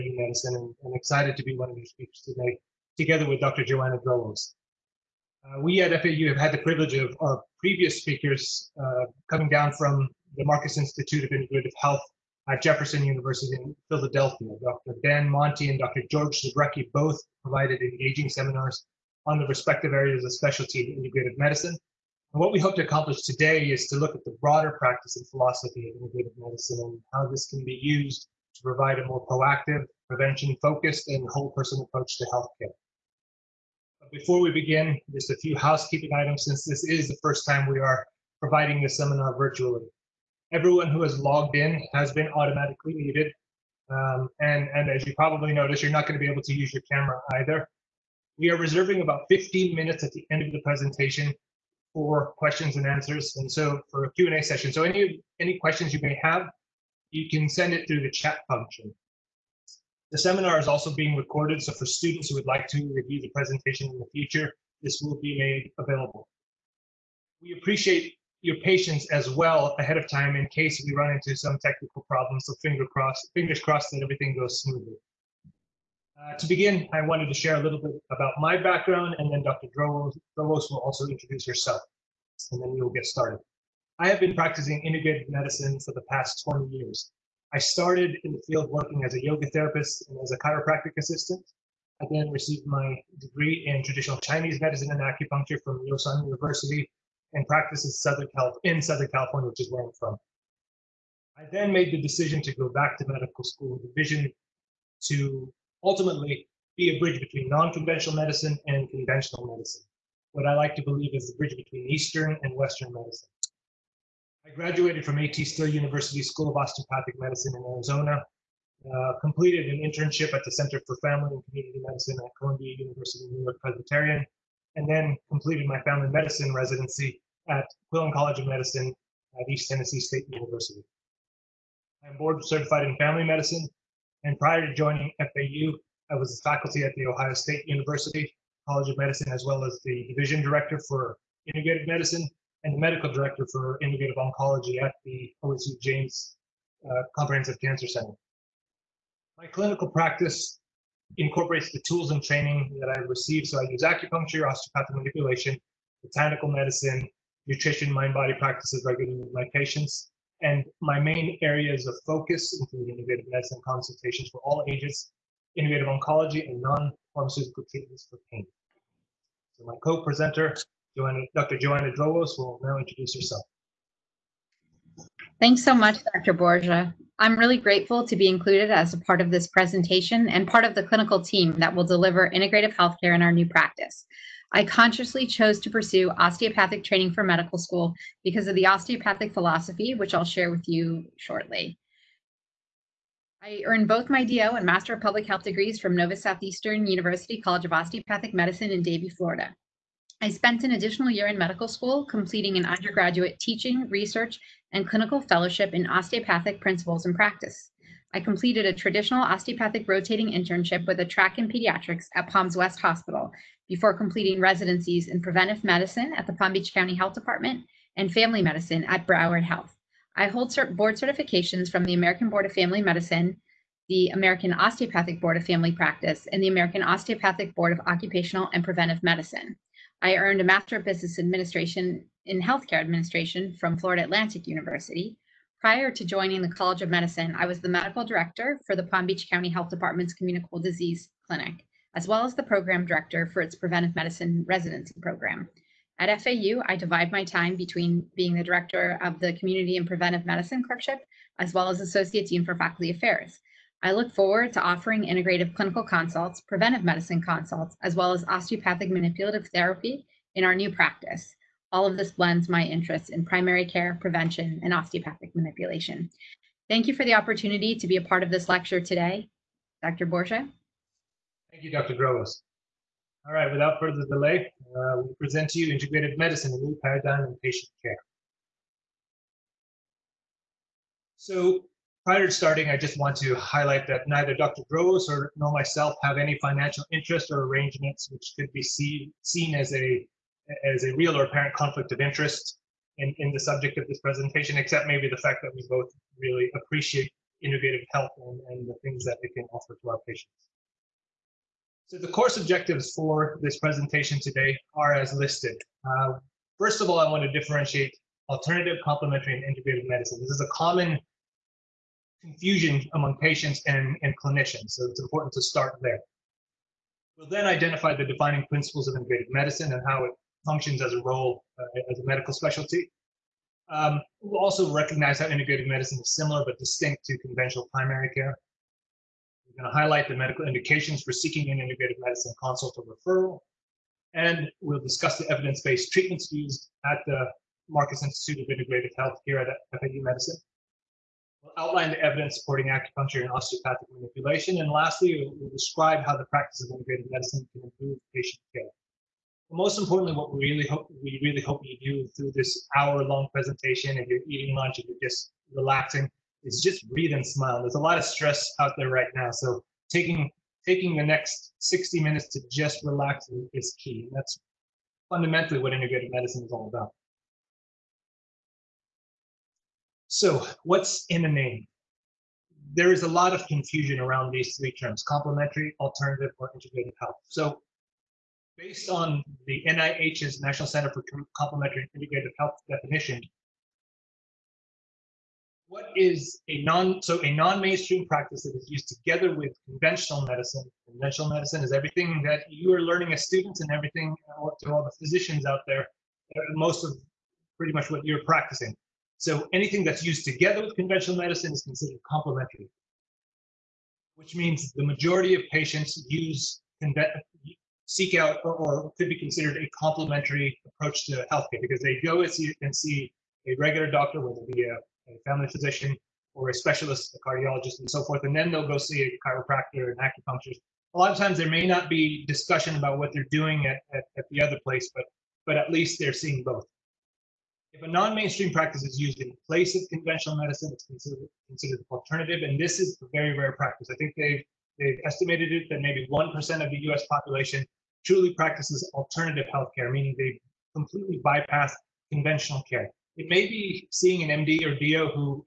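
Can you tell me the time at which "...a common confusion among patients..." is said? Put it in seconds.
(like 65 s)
310 s.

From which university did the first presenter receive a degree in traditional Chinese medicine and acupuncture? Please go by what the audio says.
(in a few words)
Yosan University.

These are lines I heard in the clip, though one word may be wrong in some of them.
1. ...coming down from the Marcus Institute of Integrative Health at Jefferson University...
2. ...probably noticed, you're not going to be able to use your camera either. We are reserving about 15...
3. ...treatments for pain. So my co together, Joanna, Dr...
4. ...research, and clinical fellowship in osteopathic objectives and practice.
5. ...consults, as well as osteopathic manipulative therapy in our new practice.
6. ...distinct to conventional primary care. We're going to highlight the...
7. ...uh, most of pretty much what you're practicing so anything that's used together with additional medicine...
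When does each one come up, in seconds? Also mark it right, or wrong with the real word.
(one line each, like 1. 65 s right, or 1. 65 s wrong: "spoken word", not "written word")
1. 9 s right
2. 45 s right
3. 167 s wrong: "presenter", not "together"
4. 203 s wrong: "principles", not "objectives"
5. 257 s right
6. 326 s right
7. 395 s wrong: "conventional", not "additional".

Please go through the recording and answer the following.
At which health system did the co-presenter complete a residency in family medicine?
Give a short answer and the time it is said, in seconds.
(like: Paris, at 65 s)
Broward Health, at 219 s.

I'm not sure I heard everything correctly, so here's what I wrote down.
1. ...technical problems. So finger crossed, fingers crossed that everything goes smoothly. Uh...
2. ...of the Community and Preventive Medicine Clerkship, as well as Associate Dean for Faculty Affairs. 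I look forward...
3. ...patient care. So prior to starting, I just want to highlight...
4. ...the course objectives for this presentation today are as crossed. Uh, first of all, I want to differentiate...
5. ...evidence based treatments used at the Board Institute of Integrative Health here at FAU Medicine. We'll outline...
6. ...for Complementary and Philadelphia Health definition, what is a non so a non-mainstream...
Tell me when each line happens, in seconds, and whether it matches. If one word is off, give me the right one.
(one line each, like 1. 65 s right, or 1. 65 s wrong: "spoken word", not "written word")
1. 71 s right
2. 249 s right
3. 277 s right
4. 301 s wrong: "listed", not "crossed"
5. 335 s wrong: "Marcus", not "Board"
6. 380 s wrong: "Integrative", not "Philadelphia".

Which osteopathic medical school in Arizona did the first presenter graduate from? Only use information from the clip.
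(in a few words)
A.T. Still University.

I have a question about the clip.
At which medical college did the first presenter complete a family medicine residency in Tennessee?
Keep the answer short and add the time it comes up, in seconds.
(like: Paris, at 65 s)
Quillen College of Medicine, at 127 s.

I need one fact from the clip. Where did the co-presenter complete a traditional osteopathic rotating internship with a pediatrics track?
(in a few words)
Palms West Hospital.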